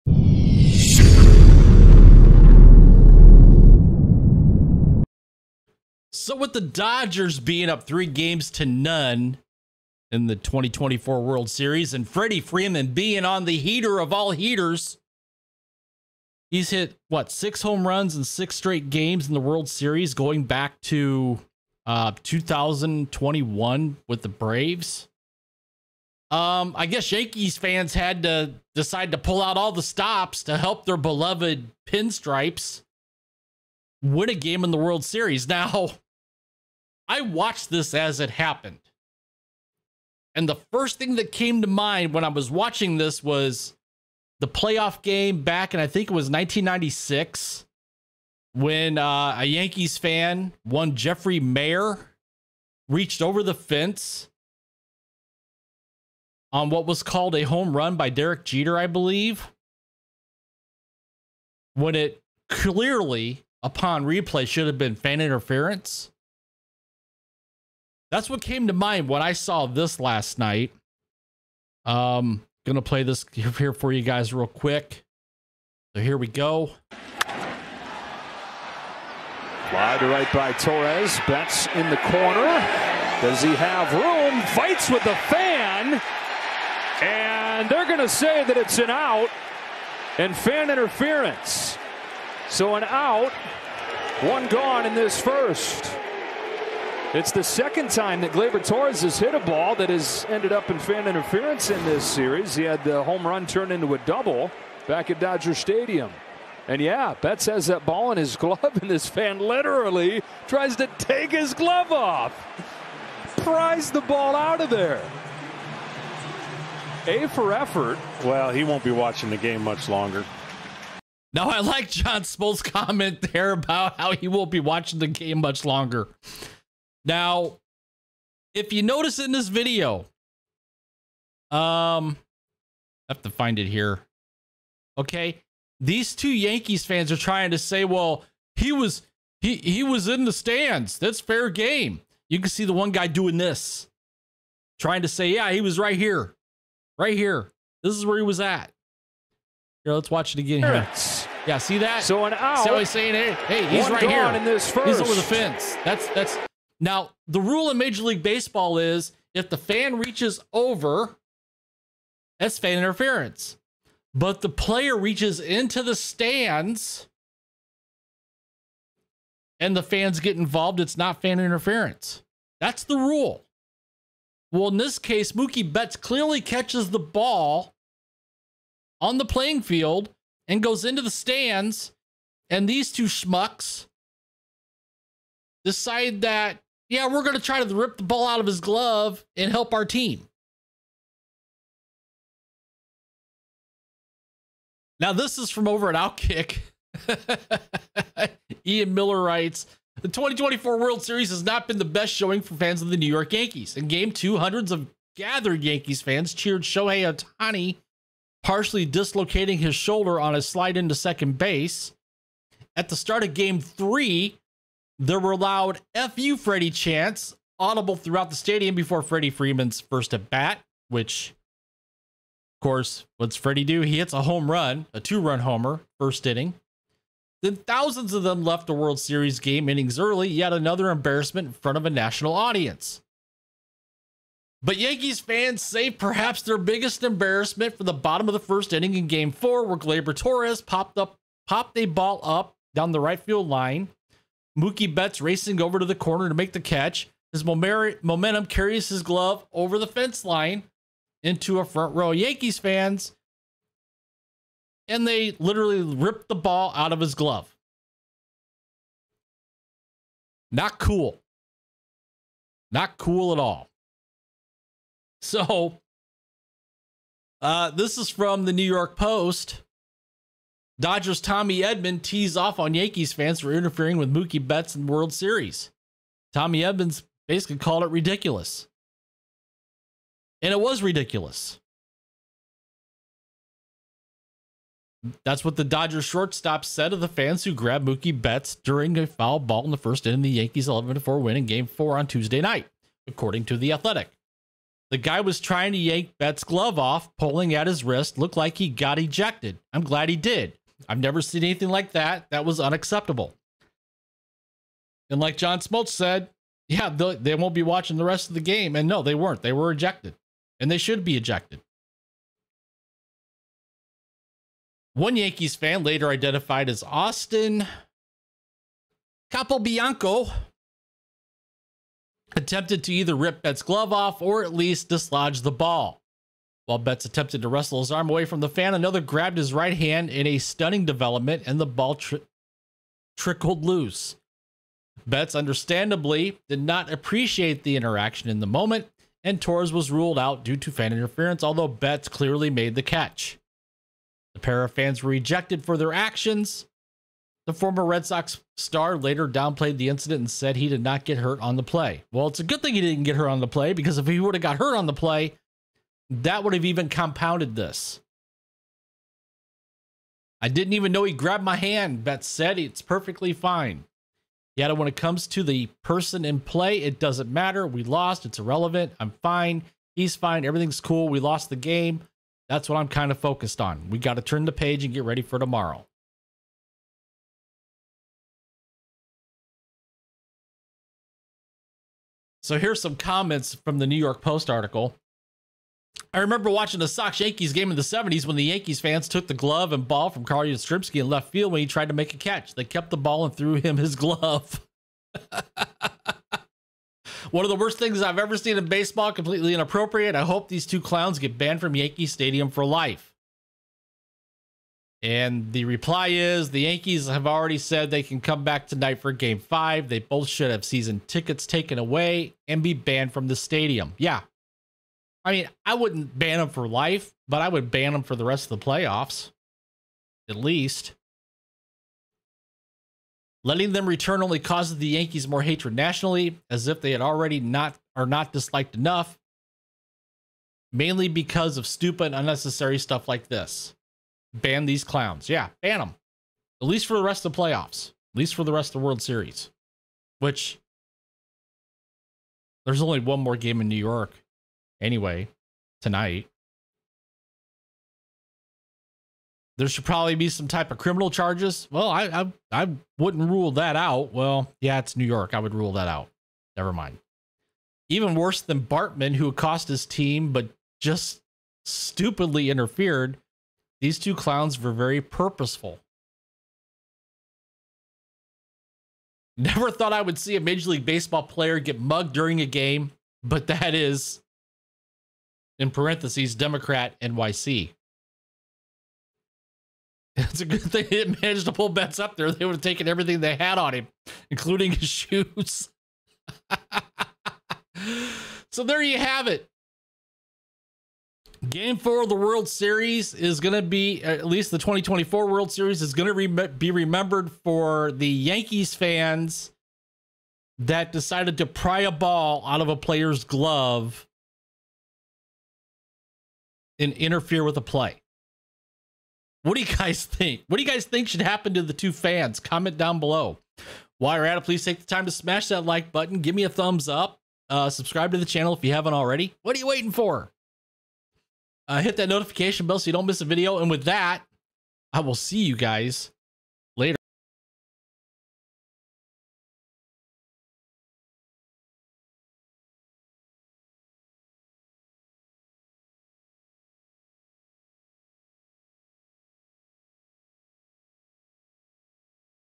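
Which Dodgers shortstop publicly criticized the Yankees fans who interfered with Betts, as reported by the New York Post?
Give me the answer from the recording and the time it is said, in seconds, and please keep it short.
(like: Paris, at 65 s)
Tommy Edman, at 271 s.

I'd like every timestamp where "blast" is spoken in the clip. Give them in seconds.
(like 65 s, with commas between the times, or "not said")
not said.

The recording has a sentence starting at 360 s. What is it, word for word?
I didn't even know he grabbed my hand.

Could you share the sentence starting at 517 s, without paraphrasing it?
Uh, subscribe to the channel if you haven't already.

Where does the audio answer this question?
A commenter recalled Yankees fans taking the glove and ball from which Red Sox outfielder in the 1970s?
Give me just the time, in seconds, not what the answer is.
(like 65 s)
390 s.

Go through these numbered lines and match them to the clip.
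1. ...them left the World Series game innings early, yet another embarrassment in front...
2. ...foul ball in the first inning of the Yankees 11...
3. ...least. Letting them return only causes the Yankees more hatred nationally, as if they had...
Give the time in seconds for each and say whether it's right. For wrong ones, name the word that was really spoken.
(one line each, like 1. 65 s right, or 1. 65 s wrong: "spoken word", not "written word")
1. 228 s right
2. 289 s right
3. 420 s right.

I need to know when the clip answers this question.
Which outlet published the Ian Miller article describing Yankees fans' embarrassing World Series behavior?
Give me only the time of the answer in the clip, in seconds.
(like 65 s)
195 s.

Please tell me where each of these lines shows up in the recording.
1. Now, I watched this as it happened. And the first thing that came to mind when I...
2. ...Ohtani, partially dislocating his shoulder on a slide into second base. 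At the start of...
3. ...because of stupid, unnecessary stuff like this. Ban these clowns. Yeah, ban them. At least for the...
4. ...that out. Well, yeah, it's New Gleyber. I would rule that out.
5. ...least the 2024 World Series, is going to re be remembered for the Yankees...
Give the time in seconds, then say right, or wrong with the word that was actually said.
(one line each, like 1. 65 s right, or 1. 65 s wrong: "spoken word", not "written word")
1. 35 s right
2. 207 s right
3. 431 s right
4. 453 s wrong: "York", not "Gleyber"
5. 494 s right.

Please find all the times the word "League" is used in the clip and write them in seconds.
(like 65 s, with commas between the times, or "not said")
158 s, 470 s.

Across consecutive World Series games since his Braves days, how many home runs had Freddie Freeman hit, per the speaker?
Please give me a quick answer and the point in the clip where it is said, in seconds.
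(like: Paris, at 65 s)
6, at 17 s.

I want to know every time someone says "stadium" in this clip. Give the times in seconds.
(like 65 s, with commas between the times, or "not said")
105 s, 218 s, 402 s, 413 s.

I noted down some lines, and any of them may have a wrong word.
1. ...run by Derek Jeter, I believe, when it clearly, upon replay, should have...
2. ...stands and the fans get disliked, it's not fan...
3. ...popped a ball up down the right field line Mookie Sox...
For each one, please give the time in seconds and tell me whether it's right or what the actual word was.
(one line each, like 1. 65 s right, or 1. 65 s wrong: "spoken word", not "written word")
1. 57 s right
2. 165 s wrong: "involved", not "disliked"
3. 241 s wrong: "Betts", not "Sox".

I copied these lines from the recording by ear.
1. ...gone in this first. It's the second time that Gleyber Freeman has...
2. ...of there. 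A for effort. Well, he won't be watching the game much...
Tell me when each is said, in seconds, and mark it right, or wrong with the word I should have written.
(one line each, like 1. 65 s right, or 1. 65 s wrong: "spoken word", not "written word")
1. 94 s wrong: "Torres", not "Freeman"
2. 114 s right.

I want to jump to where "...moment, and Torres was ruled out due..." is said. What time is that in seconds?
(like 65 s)
338 s.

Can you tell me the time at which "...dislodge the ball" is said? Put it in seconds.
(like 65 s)
324 s.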